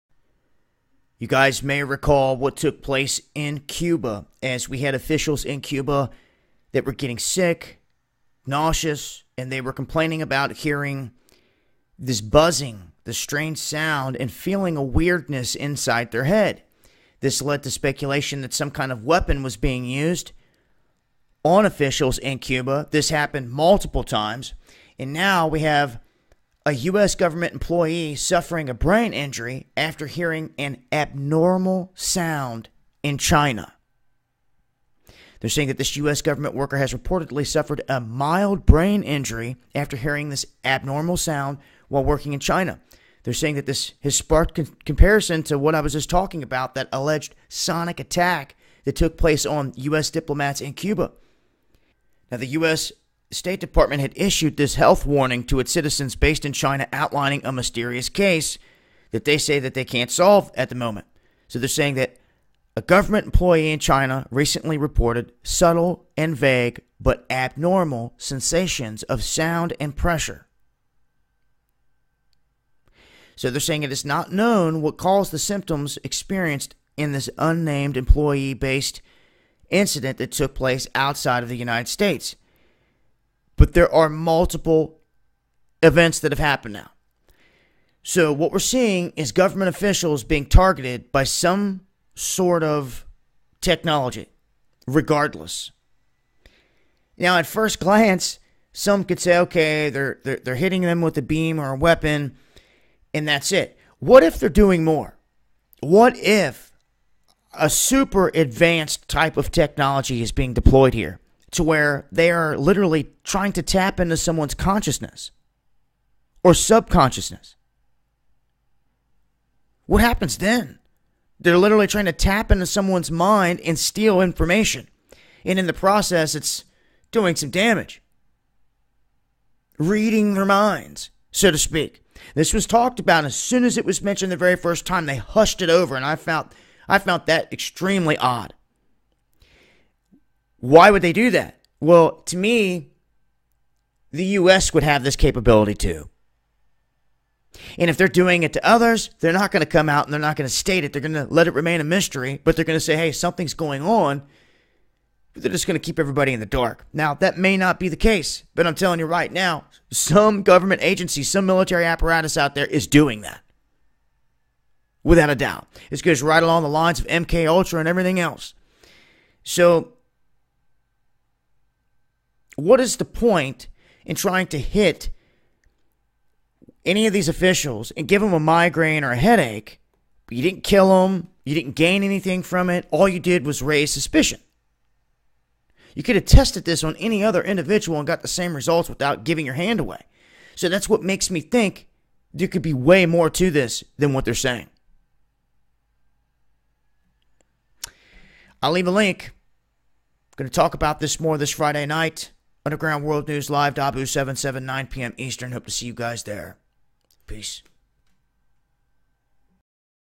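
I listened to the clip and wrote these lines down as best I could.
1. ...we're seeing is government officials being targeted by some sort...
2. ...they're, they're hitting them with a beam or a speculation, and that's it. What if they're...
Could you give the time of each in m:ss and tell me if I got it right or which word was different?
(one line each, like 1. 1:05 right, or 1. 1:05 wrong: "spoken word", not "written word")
1. 1:28 right
2. 1:40 wrong: "weapon", not "speculation".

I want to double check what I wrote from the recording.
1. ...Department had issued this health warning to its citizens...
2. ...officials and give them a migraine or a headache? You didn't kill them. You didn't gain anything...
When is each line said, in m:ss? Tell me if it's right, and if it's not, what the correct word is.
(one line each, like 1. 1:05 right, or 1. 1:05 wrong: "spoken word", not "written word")
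1. 0:53 right
2. 2:57 right.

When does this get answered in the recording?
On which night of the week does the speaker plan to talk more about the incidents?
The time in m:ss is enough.
3:21.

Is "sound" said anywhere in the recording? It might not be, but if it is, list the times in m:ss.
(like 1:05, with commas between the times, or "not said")
0:13, 0:31, 0:41, 1:09.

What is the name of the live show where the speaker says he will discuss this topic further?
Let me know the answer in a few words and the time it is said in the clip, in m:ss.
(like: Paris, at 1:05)
Underground World News Live, at 3:22.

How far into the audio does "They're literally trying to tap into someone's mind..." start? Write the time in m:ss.
2:01.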